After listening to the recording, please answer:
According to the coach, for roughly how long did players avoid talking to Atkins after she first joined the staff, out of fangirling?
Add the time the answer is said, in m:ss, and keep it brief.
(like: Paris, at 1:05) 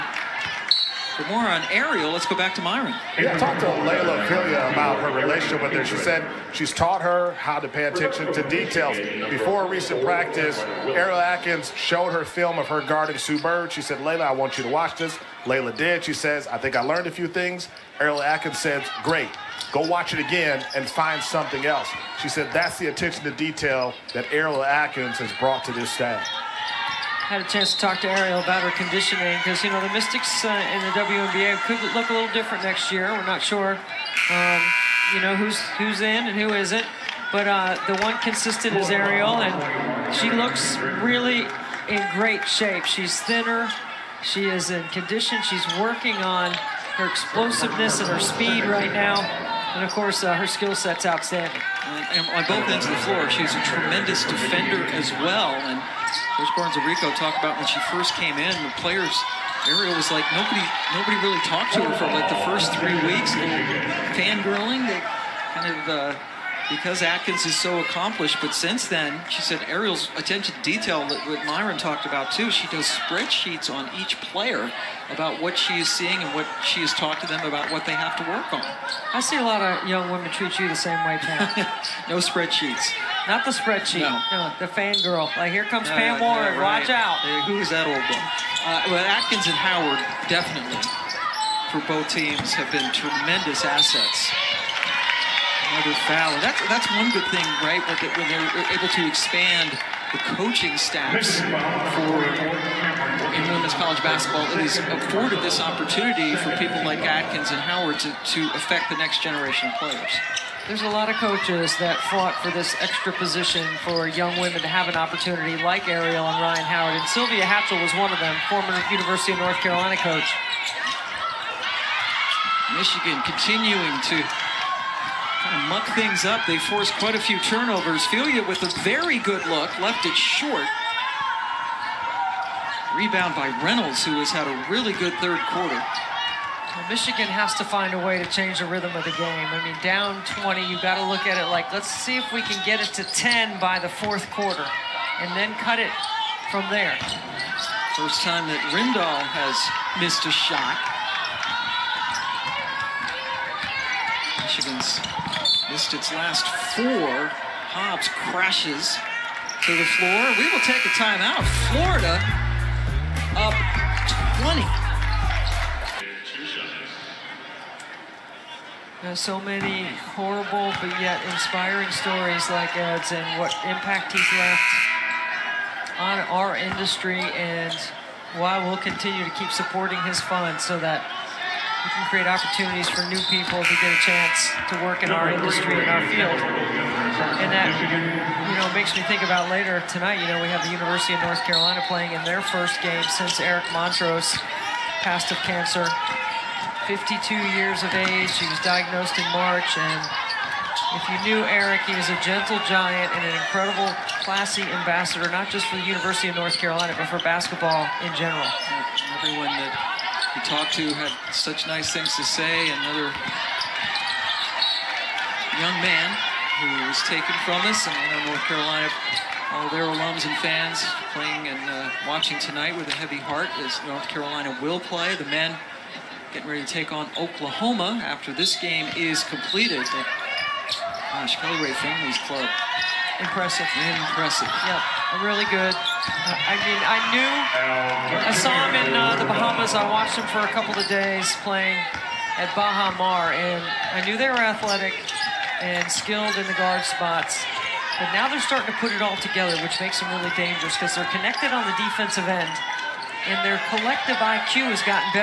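3 weeks, at 1:02.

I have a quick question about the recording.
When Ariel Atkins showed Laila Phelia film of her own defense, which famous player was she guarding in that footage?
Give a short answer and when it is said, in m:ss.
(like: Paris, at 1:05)
Sue Bird, at 0:13.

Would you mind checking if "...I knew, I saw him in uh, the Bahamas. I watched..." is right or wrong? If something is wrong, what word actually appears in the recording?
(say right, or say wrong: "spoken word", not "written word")
right.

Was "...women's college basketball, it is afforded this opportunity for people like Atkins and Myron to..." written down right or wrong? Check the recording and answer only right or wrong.
wrong.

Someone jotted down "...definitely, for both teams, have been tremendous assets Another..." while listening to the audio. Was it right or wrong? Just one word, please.
right.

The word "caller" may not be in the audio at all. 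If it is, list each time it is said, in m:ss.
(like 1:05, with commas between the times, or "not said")
not said.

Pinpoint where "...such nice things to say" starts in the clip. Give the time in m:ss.
3:31.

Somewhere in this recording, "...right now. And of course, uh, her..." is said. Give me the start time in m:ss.
0:48.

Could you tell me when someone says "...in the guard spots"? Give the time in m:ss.
4:06.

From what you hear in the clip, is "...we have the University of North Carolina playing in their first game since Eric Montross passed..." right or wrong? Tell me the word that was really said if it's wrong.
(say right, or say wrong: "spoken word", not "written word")
right.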